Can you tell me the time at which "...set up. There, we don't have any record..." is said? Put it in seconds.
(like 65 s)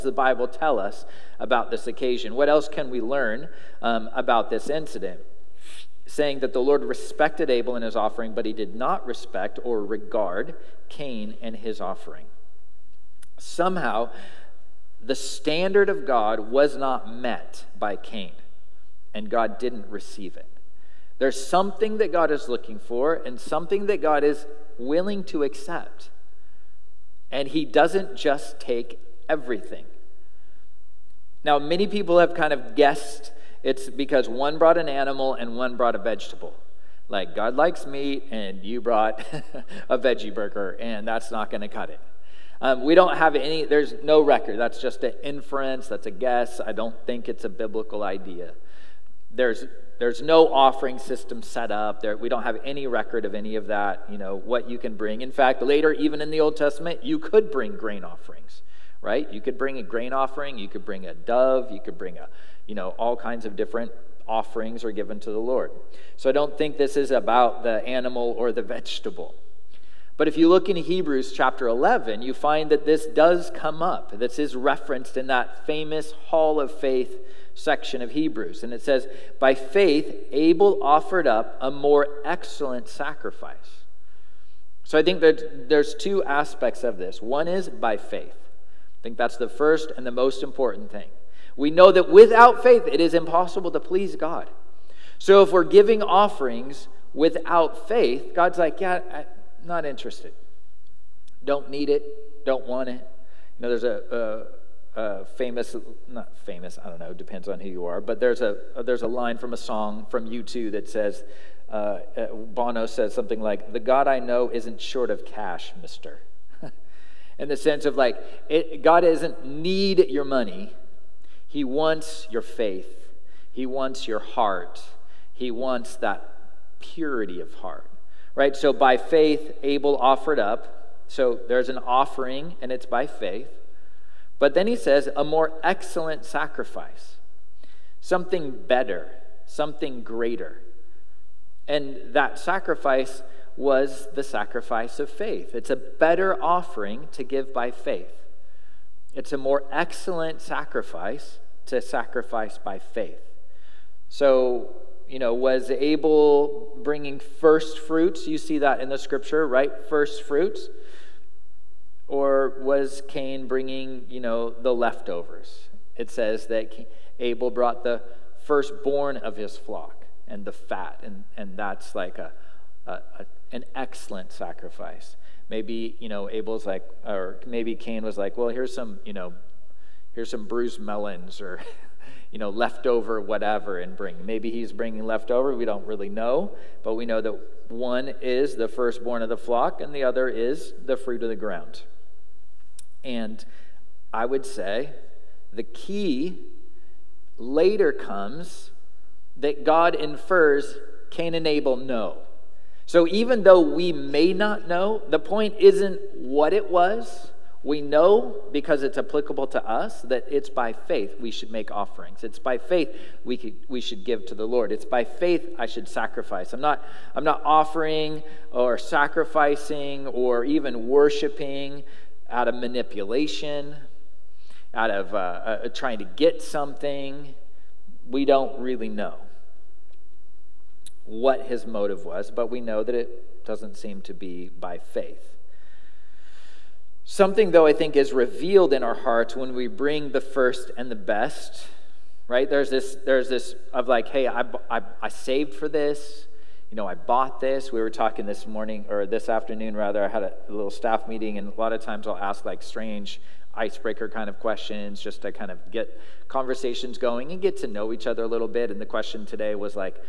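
51 s.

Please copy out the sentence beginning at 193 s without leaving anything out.
And I would say the key later comes that God infers Cain and Abel know.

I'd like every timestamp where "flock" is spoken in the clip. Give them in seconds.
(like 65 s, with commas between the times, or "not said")
169 s, 189 s.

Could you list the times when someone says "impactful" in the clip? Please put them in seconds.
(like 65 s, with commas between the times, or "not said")
not said.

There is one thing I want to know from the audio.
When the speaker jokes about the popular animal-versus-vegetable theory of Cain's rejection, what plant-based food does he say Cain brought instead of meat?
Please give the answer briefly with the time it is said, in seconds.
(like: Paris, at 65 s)
veggie burger, at 39 s.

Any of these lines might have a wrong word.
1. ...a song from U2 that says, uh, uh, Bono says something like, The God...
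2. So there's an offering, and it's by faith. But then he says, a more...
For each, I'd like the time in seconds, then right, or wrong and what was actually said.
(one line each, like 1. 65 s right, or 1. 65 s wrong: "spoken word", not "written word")
1. 109 s right
2. 131 s right.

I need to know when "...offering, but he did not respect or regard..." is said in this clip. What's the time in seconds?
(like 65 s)
7 s.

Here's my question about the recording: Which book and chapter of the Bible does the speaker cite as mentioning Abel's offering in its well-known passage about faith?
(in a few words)
Hebrews chapter 11.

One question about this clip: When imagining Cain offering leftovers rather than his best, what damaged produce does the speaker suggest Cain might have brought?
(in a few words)
bruised melons.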